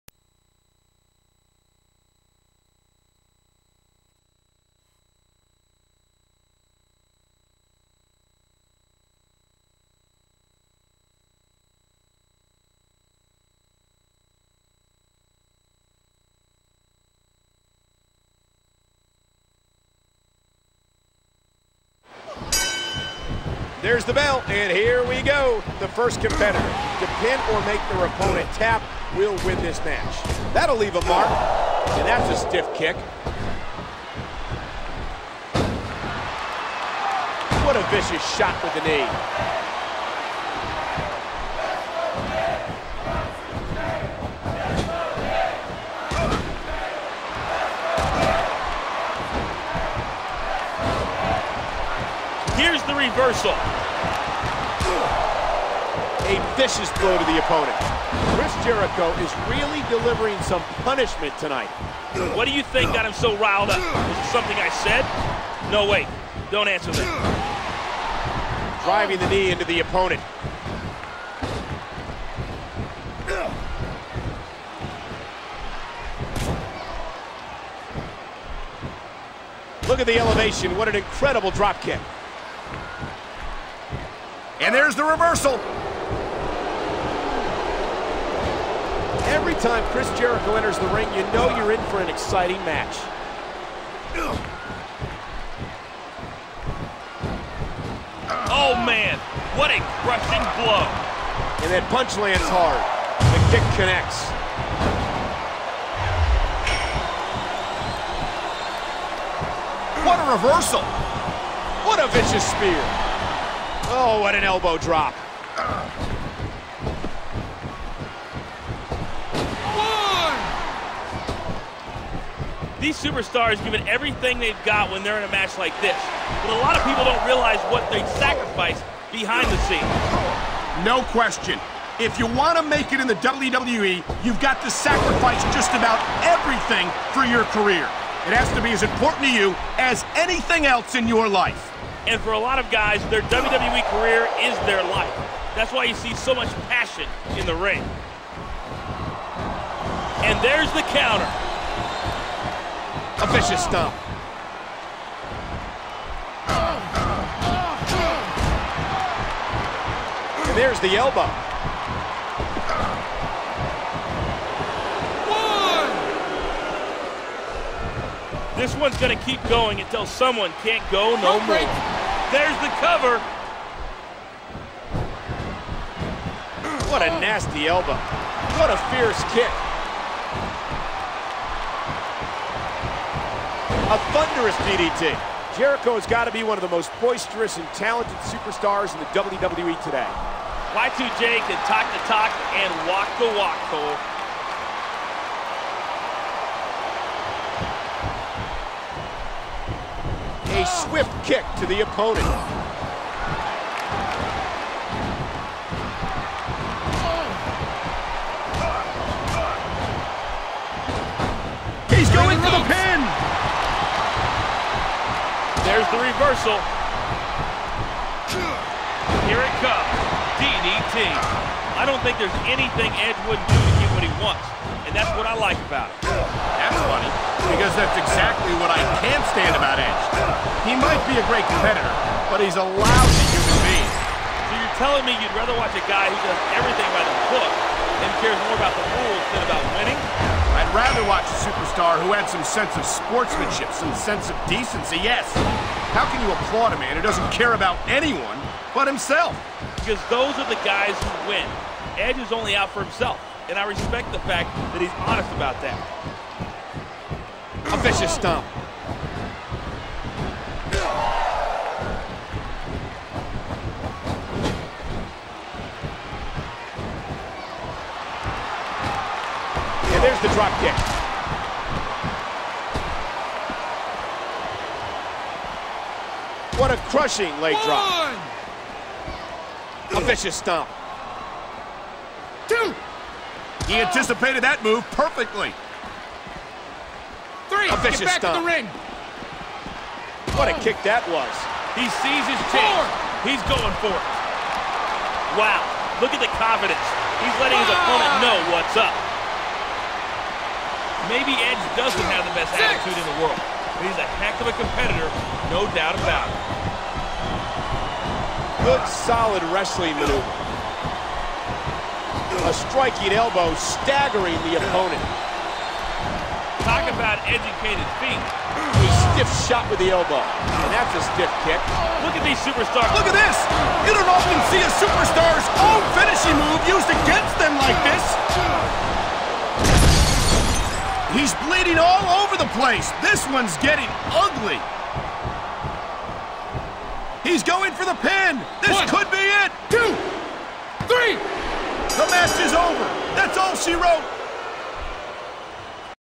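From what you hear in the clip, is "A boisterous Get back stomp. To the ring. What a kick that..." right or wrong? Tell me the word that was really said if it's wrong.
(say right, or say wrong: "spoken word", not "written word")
wrong: "vicious", not "boisterous".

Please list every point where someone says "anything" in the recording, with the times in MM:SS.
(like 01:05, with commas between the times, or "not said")
02:20, 03:42.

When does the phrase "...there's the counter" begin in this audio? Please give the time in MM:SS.
02:30.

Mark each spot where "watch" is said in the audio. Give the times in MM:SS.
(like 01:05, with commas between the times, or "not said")
03:55, 04:01.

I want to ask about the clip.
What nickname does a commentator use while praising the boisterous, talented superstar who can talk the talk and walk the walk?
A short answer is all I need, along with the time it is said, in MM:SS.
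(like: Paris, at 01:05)
Y2J, at 03:10.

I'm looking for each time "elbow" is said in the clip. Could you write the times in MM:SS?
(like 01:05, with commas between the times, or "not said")
01:54, 02:40, 02:57, 05:13, 05:19.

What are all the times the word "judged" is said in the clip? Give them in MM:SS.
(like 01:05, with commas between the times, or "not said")
not said.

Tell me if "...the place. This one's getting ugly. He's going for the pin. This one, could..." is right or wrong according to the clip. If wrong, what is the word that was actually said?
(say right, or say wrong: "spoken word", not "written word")
right.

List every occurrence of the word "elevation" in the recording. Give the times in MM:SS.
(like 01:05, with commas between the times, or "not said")
01:20.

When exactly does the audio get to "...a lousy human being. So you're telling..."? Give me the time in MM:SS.
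03:52.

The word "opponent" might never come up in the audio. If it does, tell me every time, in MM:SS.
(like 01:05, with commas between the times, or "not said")
00:28, 00:57, 01:09, 03:21, 04:57, 05:14.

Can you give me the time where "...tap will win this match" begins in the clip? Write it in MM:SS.
00:28.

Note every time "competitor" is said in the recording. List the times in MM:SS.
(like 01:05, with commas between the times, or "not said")
00:26, 03:51, 05:04.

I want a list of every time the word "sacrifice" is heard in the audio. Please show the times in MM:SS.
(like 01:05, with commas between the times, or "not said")
02:08, 02:14.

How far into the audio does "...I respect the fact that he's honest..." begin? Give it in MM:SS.
04:13.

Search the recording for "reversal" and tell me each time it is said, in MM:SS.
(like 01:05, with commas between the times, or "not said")
00:52, 01:25, 01:50, 03:35.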